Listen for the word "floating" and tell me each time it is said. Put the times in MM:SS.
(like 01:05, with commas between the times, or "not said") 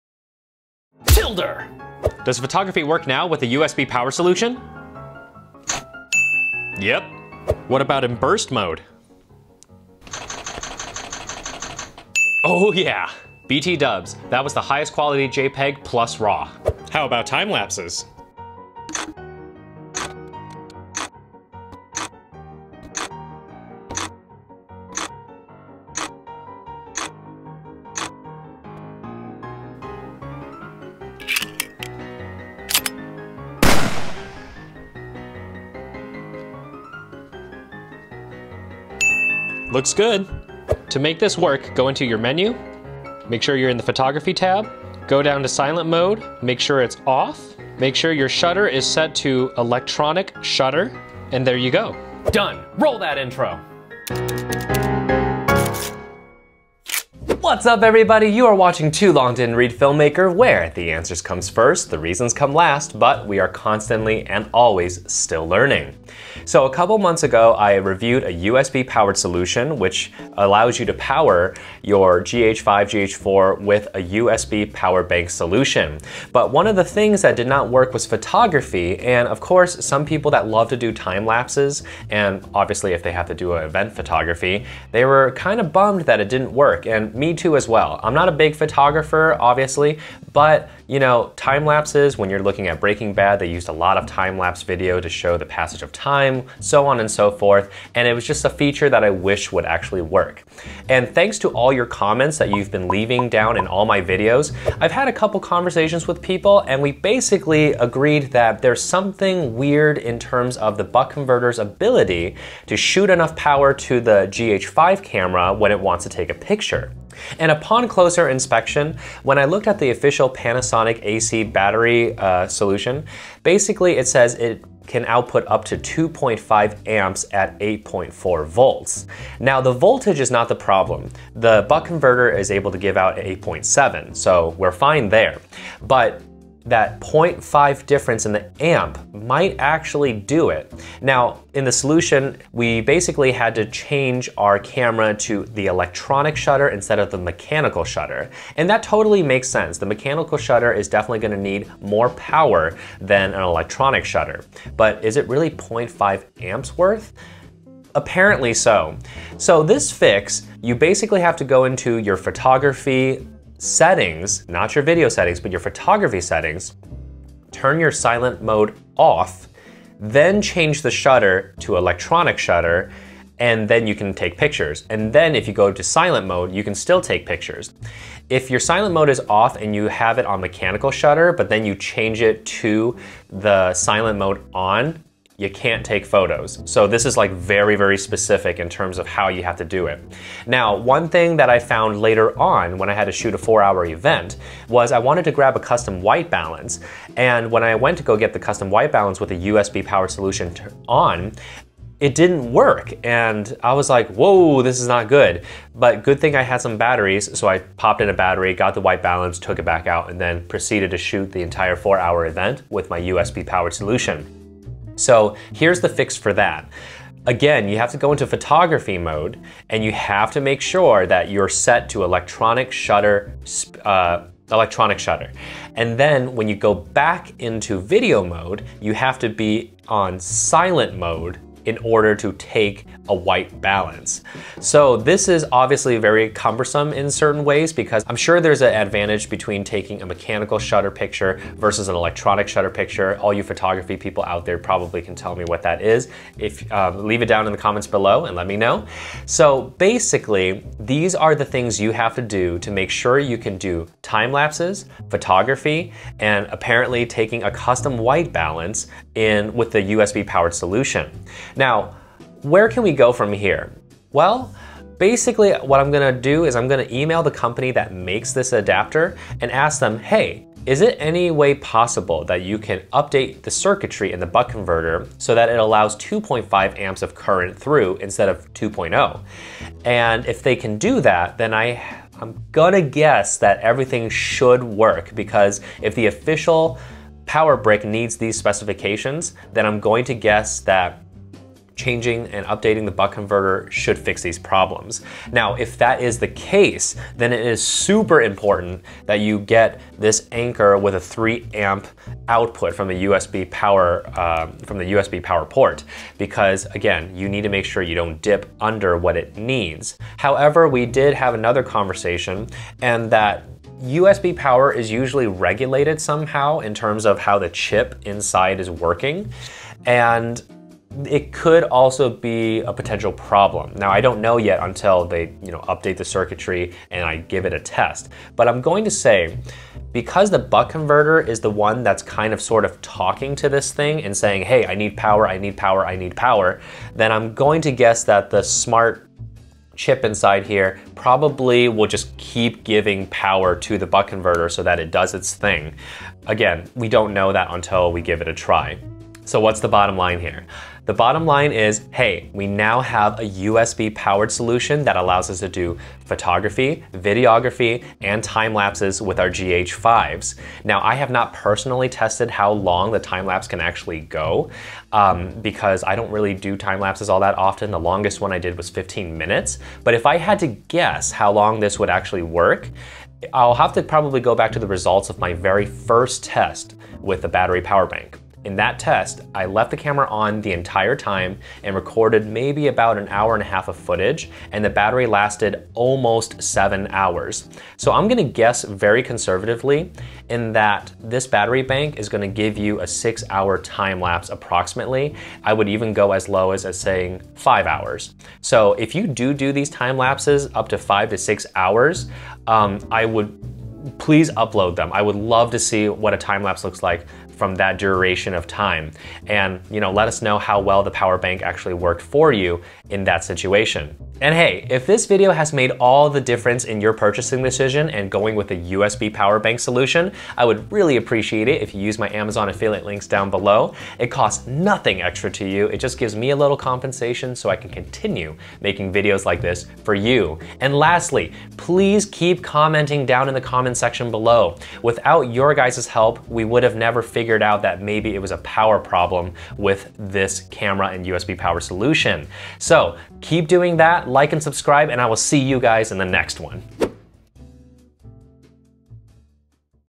not said.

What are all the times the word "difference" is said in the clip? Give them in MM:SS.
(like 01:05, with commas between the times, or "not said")
02:17, 06:56.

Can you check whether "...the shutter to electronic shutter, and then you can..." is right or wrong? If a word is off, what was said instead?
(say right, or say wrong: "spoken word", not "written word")
right.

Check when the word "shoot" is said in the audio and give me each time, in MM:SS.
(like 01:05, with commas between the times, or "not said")
01:52, 03:13, 03:30.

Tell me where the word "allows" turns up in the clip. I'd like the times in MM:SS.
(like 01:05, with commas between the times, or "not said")
01:10, 04:35, 05:54.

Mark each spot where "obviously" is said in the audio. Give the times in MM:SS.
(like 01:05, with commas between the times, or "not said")
01:22, 01:29, 03:55.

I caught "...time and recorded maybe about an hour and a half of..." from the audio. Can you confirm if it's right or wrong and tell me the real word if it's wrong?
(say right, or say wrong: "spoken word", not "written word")
right.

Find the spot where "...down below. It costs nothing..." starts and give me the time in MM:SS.
07:03.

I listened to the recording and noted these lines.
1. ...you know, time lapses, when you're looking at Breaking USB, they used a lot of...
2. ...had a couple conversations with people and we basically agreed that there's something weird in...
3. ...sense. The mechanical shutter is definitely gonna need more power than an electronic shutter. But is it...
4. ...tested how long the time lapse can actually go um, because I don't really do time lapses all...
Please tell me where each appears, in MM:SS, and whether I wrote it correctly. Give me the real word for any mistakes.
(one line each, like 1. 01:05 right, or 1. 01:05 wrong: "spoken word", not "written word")
1. 01:30 wrong: "Bad", not "USB"
2. 01:44 right
3. 02:29 right
4. 06:01 right.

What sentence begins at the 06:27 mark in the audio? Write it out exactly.
So I'm gonna guess very conservatively in that this battery bank is gonna give you a six hour time lapse approximately.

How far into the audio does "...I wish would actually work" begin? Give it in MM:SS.
01:39.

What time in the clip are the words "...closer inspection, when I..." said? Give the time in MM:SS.
01:57.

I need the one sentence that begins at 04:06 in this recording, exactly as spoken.
If um, Leave it down in the comments below and let me know.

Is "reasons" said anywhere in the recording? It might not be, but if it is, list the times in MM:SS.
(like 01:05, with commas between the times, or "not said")
01:01.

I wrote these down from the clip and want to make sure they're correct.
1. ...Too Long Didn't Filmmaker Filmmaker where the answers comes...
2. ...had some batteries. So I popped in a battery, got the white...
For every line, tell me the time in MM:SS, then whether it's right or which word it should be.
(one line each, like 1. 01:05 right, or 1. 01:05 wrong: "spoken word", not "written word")
1. 00:58 wrong: "Read", not "Filmmaker"
2. 03:26 right.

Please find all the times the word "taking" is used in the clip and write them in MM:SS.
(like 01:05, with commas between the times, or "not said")
03:59, 04:17.